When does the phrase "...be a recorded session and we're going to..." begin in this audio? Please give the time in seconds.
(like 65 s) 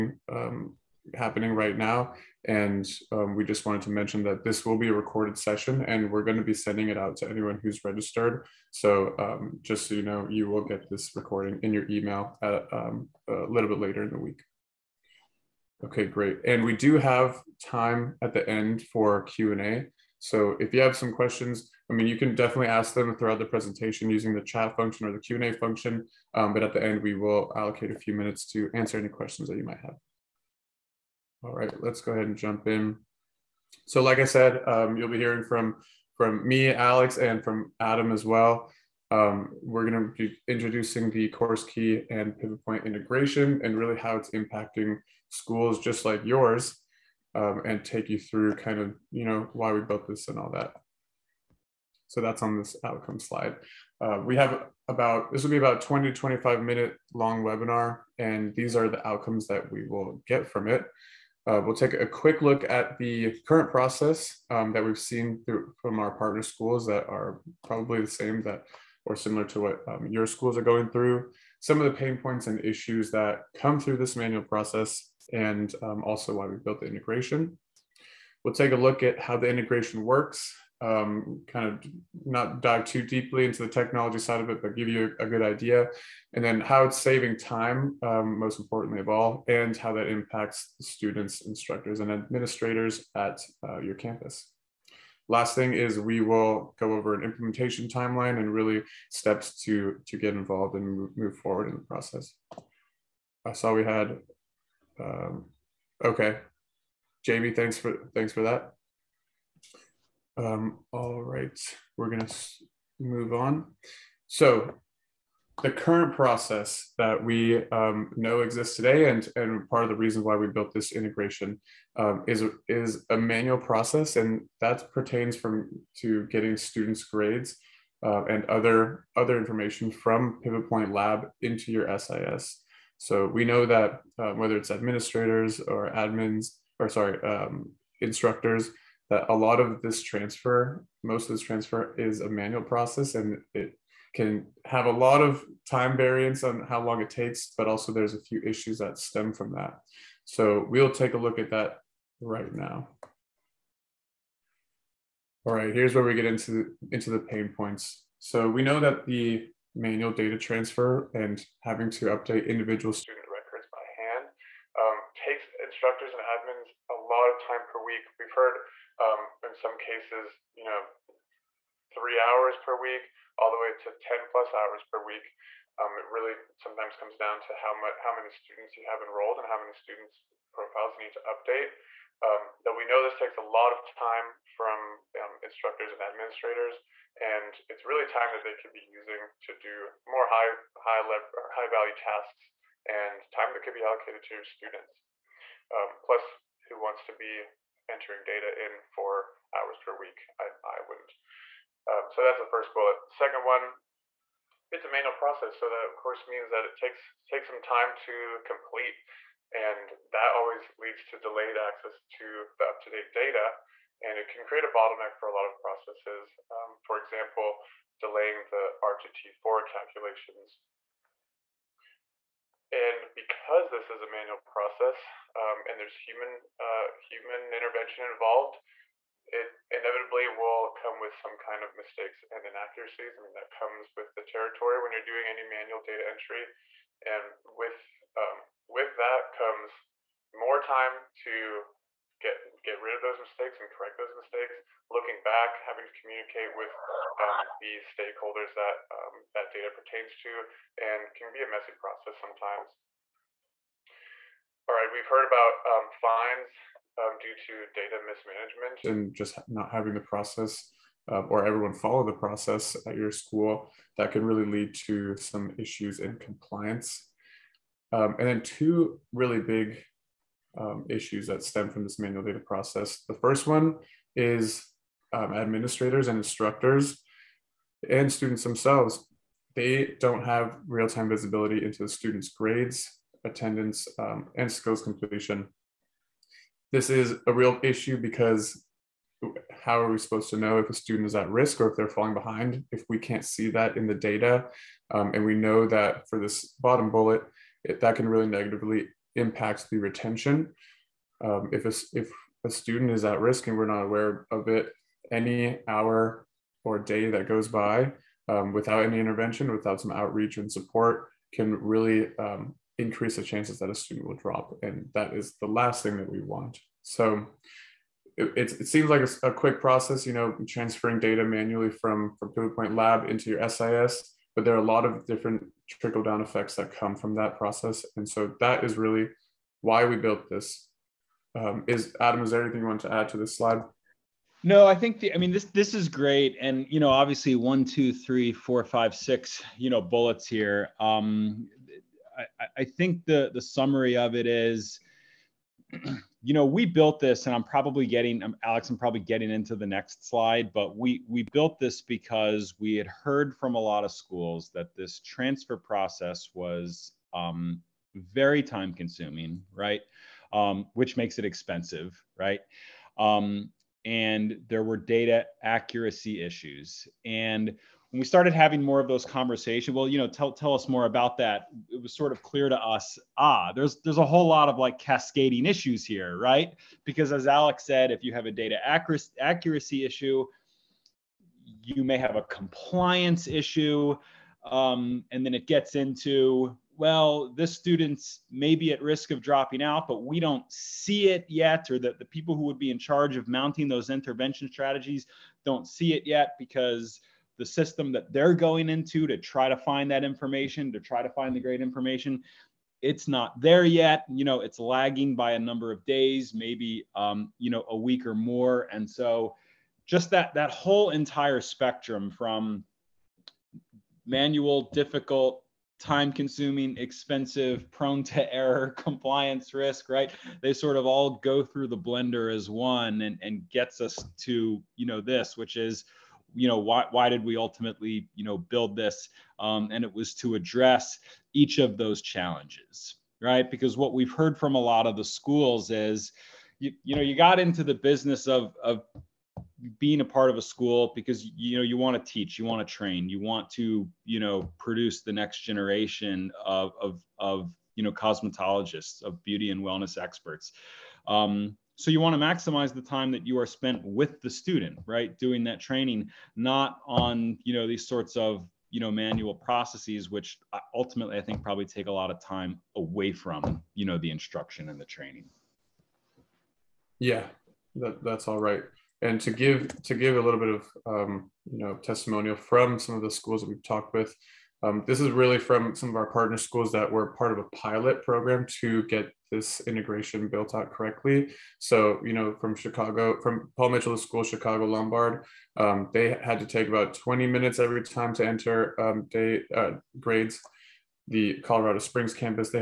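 4 s.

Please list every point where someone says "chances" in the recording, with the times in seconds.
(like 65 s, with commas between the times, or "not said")
313 s.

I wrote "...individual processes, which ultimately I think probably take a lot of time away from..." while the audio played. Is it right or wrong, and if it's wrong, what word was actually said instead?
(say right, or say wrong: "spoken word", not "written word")
wrong: "manual", not "individual".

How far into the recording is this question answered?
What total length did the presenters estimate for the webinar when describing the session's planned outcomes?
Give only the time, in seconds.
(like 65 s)
55 s.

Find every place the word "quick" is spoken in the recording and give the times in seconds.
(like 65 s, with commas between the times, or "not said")
62 s, 319 s.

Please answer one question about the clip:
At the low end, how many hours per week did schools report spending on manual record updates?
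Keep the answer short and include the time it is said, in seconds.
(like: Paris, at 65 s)
3, at 171 s.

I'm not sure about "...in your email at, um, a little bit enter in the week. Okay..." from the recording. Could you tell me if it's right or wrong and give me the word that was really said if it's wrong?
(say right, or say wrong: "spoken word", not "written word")
wrong: "later", not "enter".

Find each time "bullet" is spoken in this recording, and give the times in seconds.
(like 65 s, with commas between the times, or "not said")
202 s, 296 s, 339 s.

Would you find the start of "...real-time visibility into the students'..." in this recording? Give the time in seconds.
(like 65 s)
280 s.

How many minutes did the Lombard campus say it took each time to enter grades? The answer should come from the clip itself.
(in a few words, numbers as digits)
20.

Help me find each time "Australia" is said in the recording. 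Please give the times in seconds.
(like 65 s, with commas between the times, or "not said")
not said.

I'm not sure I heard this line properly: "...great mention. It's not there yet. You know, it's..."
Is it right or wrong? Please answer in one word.
wrong.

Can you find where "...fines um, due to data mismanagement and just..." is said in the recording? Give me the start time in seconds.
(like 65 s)
255 s.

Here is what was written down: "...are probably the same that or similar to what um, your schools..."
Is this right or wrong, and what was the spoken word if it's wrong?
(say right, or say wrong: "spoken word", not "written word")
right.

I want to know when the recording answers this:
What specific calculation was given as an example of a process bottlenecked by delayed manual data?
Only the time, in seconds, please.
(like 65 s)
218 s.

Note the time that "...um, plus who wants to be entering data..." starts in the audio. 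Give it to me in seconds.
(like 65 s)
195 s.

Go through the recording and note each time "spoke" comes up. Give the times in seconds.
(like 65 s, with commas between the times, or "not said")
not said.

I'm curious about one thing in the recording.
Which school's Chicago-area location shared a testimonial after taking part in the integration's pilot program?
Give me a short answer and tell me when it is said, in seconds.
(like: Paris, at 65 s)
Paul Mitchell School, at 483 s.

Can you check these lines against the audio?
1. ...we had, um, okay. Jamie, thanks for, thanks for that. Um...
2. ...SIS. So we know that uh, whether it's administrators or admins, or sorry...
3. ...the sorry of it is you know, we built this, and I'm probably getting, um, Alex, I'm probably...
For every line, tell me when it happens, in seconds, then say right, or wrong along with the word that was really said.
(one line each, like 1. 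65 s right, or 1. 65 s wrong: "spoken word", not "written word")
1. 103 s right
2. 131 s right
3. 343 s wrong: "summary", not "sorry".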